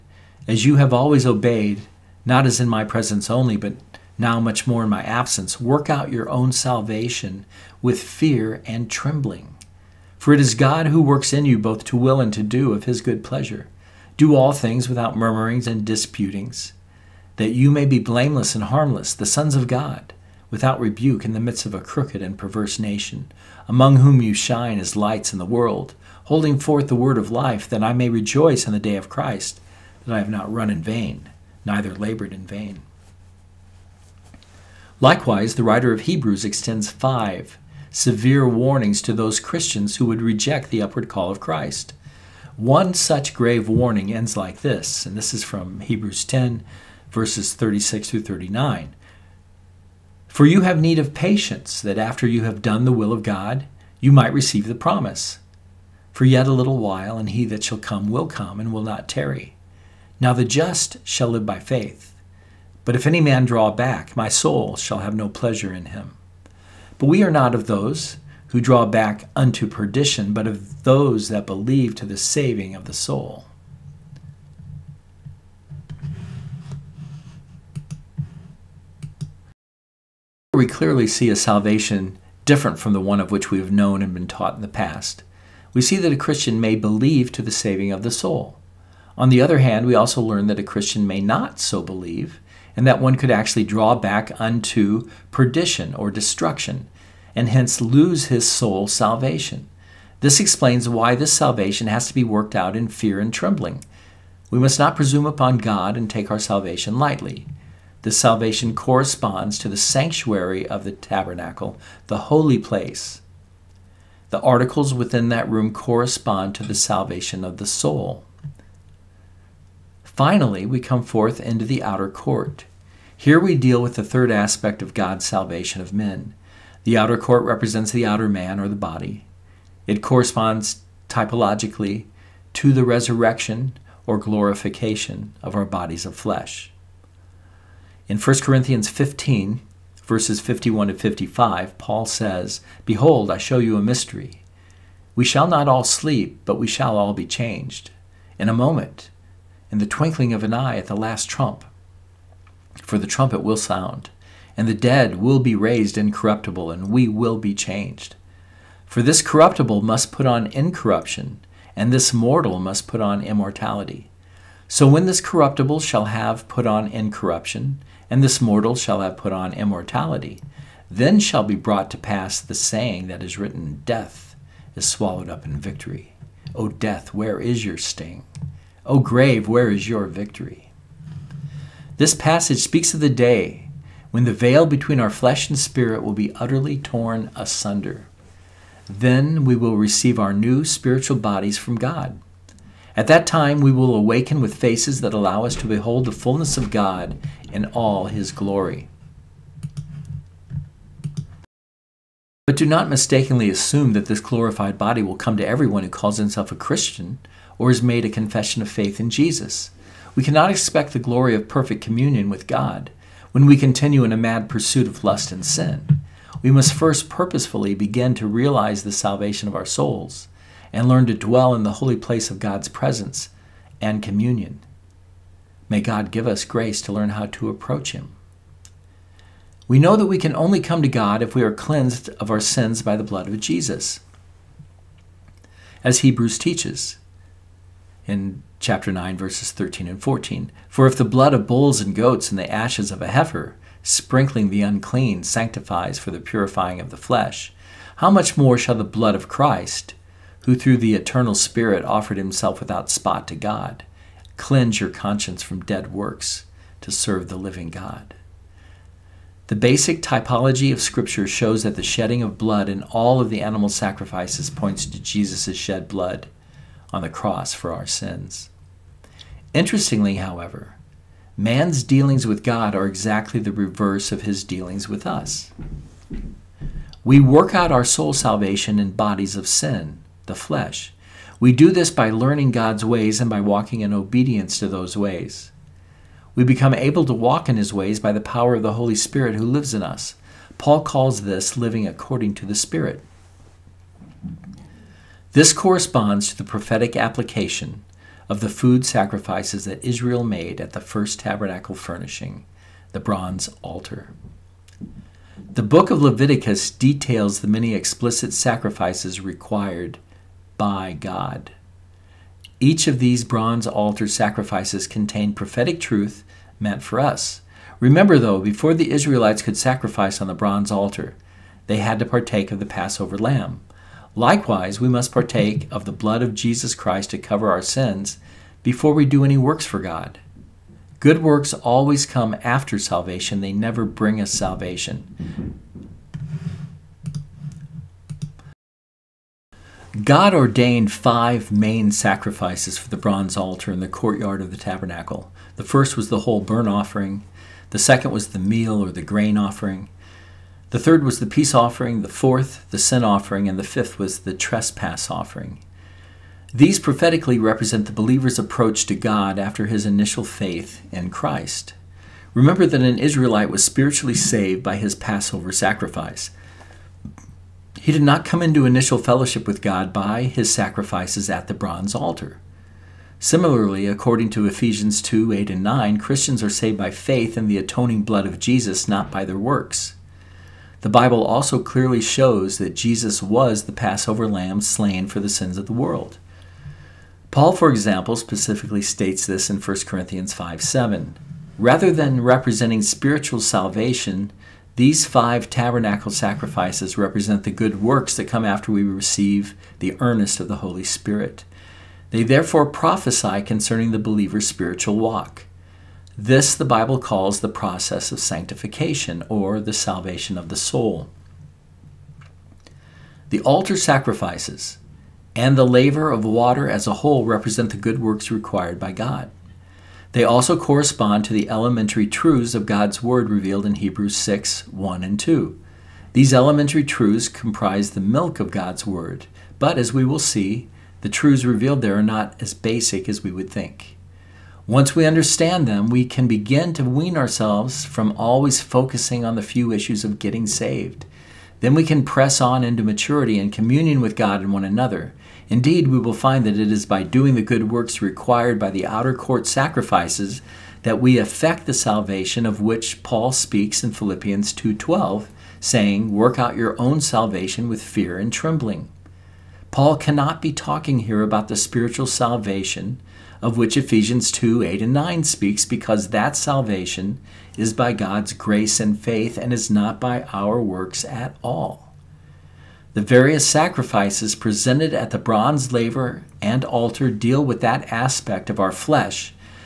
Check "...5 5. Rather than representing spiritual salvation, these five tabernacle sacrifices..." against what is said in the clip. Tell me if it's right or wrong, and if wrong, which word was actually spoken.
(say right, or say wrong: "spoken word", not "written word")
wrong: "7", not "5".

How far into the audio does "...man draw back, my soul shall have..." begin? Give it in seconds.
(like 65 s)
63 s.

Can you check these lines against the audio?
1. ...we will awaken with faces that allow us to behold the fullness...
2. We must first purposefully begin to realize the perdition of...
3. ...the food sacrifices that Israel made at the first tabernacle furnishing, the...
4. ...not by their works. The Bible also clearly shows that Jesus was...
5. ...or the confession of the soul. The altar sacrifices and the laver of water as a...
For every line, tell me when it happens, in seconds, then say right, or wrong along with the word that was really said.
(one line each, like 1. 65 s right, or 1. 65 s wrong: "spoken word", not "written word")
1. 193 s right
2. 216 s wrong: "salvation", not "perdition"
3. 298 s right
4. 378 s right
5. 409 s wrong: "salvation", not "confession".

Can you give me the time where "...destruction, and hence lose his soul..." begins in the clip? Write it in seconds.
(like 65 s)
96 s.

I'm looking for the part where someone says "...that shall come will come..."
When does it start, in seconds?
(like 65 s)
57 s.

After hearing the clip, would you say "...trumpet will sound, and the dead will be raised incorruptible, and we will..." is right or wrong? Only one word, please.
right.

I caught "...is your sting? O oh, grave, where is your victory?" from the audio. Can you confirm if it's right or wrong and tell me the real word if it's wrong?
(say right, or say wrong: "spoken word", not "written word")
right.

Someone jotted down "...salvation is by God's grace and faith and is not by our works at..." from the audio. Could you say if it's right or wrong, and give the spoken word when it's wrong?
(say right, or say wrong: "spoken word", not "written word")
right.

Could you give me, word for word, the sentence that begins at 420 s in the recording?
They also correspond to the elementary truths of God's Word revealed in Hebrews 6 1 and 2.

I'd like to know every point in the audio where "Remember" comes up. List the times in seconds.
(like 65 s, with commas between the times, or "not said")
317 s, 362 s.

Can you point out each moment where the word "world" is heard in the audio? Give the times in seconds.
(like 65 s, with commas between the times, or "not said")
25 s, 385 s.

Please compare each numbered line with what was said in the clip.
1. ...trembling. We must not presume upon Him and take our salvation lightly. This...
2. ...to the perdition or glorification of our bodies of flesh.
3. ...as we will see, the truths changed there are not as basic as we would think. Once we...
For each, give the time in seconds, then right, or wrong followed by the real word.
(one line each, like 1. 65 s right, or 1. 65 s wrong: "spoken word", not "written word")
1. 103 s wrong: "God", not "Him"
2. 132 s wrong: "resurrection", not "perdition"
3. 429 s wrong: "revealed", not "changed".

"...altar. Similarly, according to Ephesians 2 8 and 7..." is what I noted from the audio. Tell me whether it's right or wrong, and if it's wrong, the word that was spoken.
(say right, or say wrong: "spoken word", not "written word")
wrong: "9", not "7".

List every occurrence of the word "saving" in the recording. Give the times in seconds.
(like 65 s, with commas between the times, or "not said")
72 s, 87 s.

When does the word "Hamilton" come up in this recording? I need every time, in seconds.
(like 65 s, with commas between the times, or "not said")
not said.